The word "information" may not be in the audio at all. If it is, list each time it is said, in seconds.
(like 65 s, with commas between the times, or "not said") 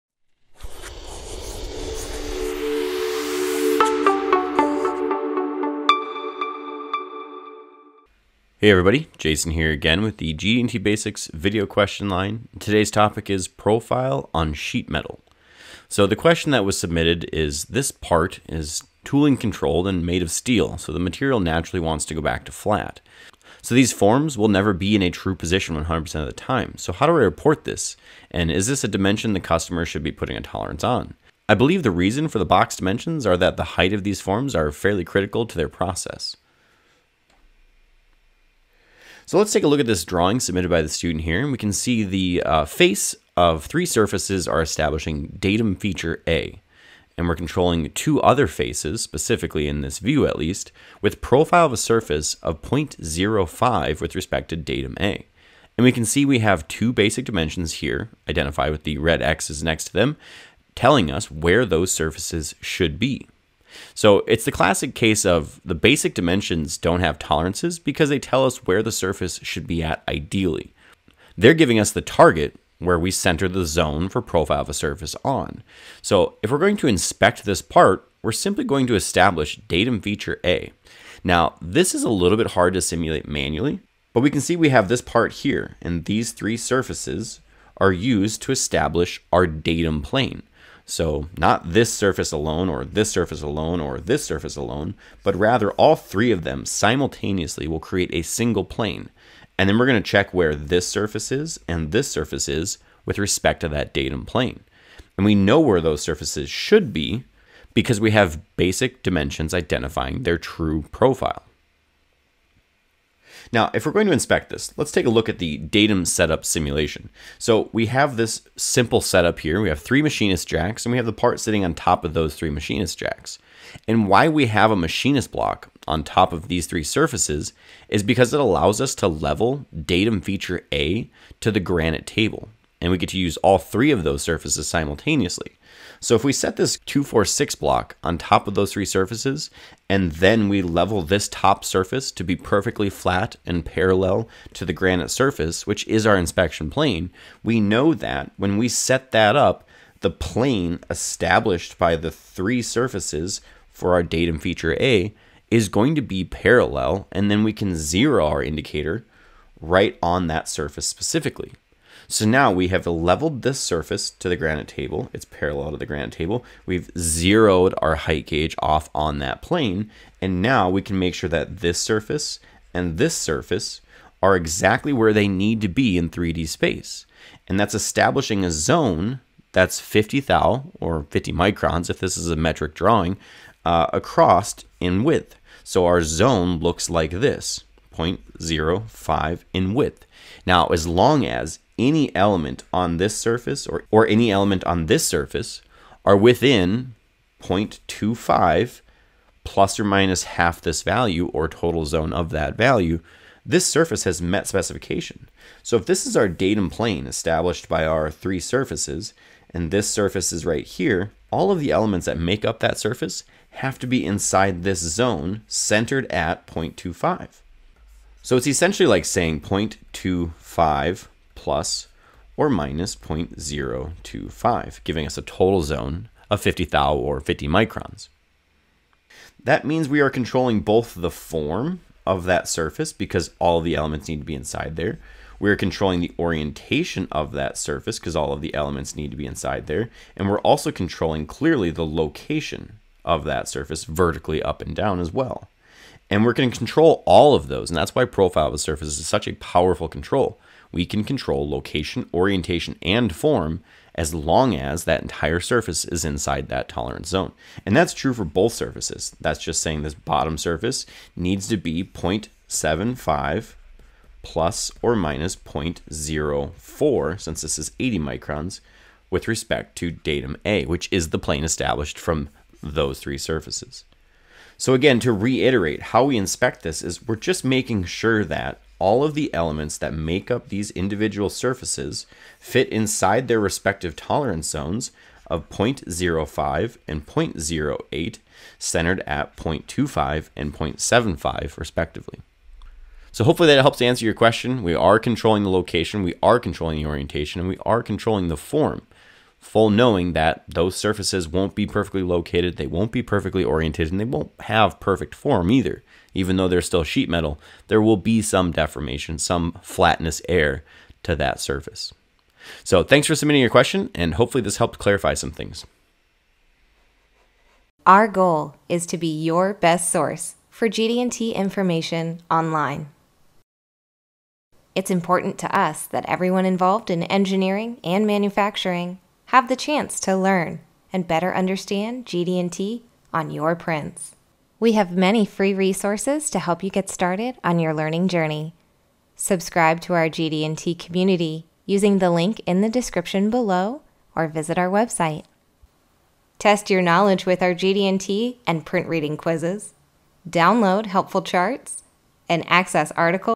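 321 s.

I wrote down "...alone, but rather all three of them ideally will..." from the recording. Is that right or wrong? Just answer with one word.
wrong.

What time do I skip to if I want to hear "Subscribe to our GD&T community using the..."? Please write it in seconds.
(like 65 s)
339 s.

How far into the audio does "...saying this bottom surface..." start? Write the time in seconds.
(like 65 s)
259 s.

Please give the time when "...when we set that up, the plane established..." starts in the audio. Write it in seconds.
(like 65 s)
148 s.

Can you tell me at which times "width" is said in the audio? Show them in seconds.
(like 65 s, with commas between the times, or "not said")
185 s, 189 s.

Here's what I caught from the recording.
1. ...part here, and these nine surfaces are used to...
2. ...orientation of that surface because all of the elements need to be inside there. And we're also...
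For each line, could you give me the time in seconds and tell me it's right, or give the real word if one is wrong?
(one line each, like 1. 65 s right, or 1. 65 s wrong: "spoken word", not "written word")
1. 85 s wrong: "three", not "nine"
2. 236 s right.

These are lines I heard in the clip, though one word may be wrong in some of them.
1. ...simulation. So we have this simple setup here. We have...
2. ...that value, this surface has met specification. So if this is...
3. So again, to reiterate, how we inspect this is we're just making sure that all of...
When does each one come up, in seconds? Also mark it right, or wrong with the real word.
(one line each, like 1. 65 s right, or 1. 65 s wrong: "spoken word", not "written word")
1. 116 s right
2. 202 s right
3. 274 s right.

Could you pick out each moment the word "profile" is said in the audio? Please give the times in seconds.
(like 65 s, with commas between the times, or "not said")
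13 s, 51 s, 74 s, 110 s, 248 s.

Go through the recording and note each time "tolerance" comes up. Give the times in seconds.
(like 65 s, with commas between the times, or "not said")
30 s, 67 s, 256 s, 283 s.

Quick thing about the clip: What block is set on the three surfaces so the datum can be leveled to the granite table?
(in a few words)
246 block.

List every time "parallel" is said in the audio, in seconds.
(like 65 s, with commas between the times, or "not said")
143 s, 156 s, 165 s.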